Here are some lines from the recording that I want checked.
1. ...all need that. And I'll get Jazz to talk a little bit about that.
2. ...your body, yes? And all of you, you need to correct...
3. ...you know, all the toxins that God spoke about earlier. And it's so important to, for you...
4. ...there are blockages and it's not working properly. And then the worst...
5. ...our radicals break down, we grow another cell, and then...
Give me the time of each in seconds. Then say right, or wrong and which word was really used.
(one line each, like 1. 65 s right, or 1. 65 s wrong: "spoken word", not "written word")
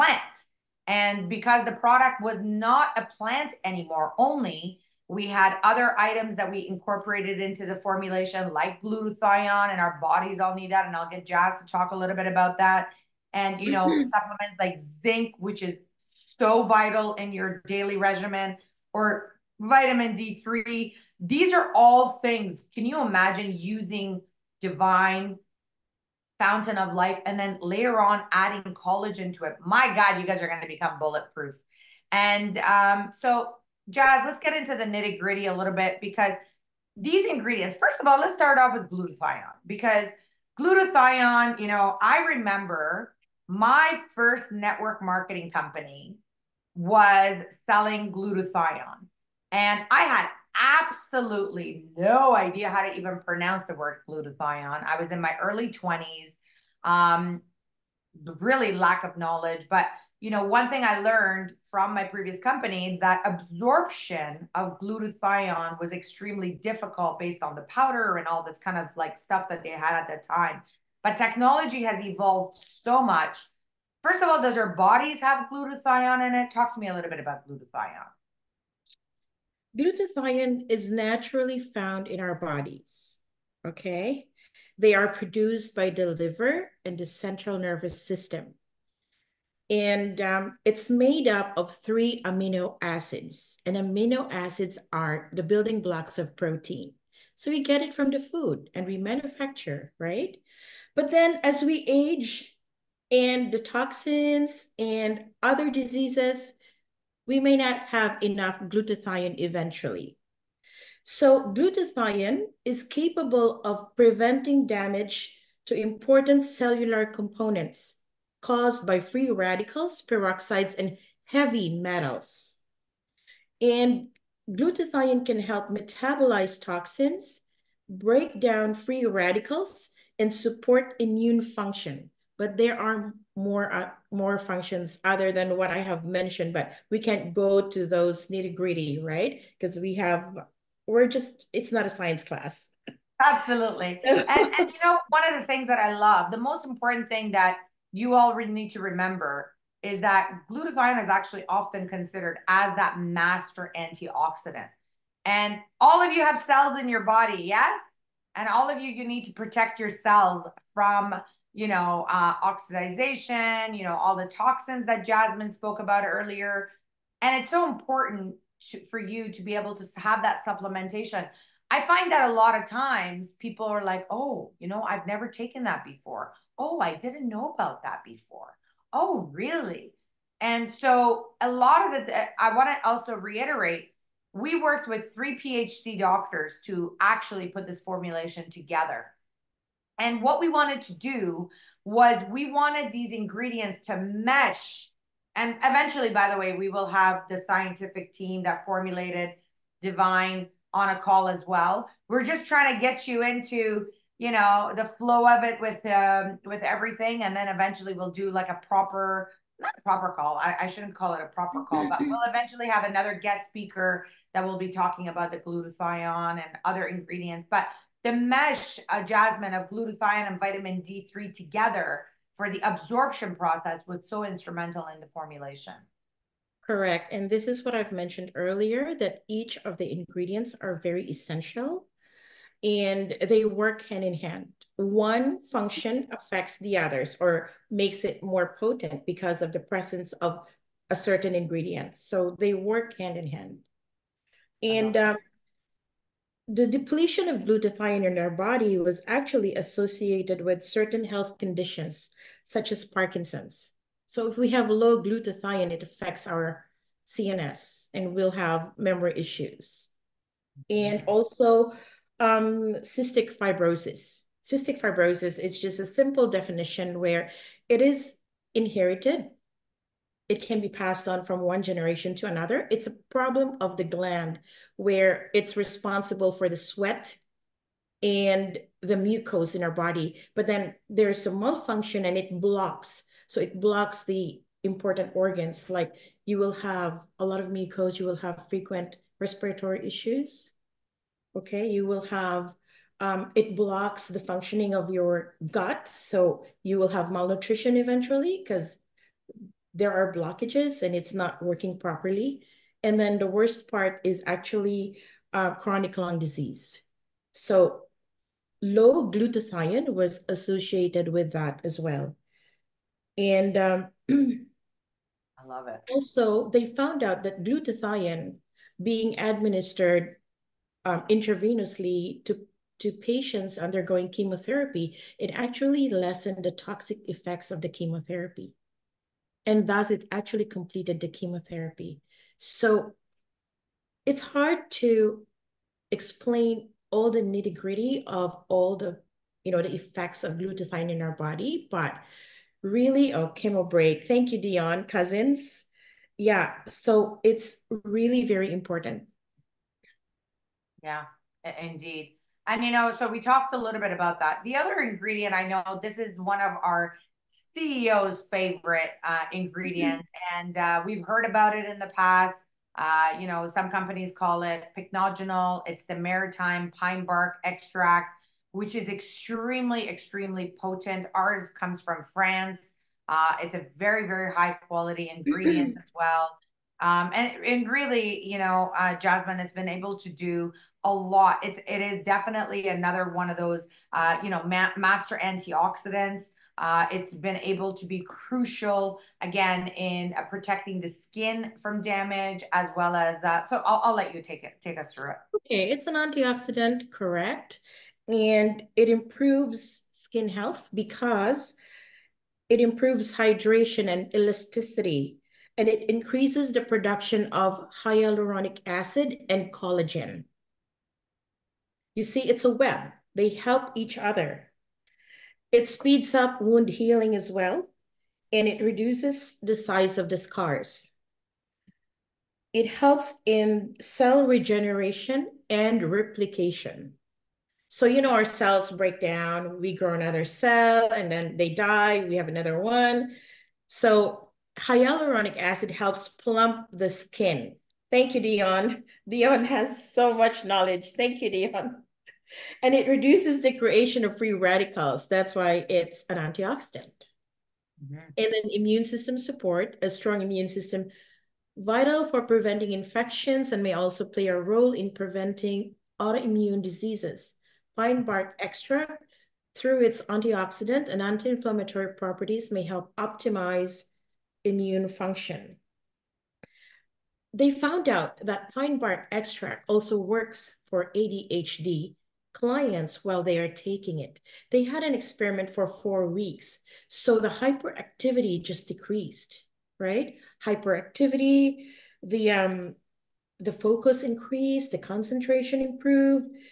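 1. 10 s right
2. 156 s wrong: "protect", not "correct"
3. 163 s wrong: "Jasmine", not "God"
4. 299 s right
5. 428 s wrong: "cells", not "radicals".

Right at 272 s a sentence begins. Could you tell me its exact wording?
It's a problem of the gland where it's responsible for the sweat and the mucose in our body.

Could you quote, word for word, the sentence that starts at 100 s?
But then as we age and the toxins and other diseases we may not have enough glutathione eventually.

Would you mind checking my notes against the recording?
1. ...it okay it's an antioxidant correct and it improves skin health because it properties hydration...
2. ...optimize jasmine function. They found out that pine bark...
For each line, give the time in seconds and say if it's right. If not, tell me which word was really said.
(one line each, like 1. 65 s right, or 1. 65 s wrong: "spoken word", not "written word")
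1. 395 s wrong: "improves", not "properties"
2. 462 s wrong: "immune", not "jasmine".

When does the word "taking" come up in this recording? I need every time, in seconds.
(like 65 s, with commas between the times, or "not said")
473 s.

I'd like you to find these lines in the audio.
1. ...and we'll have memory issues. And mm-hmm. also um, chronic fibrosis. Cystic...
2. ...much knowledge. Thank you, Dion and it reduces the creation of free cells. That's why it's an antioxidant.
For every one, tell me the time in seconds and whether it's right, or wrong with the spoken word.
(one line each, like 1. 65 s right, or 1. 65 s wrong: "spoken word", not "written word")
1. 257 s wrong: "cystic", not "chronic"
2. 440 s wrong: "radicals", not "cells".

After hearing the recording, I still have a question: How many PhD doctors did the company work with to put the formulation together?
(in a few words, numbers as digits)
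3.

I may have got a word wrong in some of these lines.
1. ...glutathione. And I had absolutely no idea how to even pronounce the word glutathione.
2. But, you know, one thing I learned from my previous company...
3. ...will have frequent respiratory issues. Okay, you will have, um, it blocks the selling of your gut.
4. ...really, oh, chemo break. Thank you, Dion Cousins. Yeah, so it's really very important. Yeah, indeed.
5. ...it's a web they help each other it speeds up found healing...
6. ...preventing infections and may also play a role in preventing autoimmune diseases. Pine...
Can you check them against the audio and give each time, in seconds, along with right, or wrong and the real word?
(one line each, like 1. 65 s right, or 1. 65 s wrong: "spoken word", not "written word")
1. 48 s right
2. 59 s right
3. 288 s wrong: "functioning", not "selling"
4. 342 s right
5. 412 s wrong: "wound", not "found"
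6. 452 s right.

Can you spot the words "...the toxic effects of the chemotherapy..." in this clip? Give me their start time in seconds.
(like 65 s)
326 s.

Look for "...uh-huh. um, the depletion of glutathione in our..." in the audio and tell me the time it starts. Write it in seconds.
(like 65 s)
244 s.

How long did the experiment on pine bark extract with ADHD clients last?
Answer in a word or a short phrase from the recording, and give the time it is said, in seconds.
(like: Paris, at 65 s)
4 weeks, at 475 s.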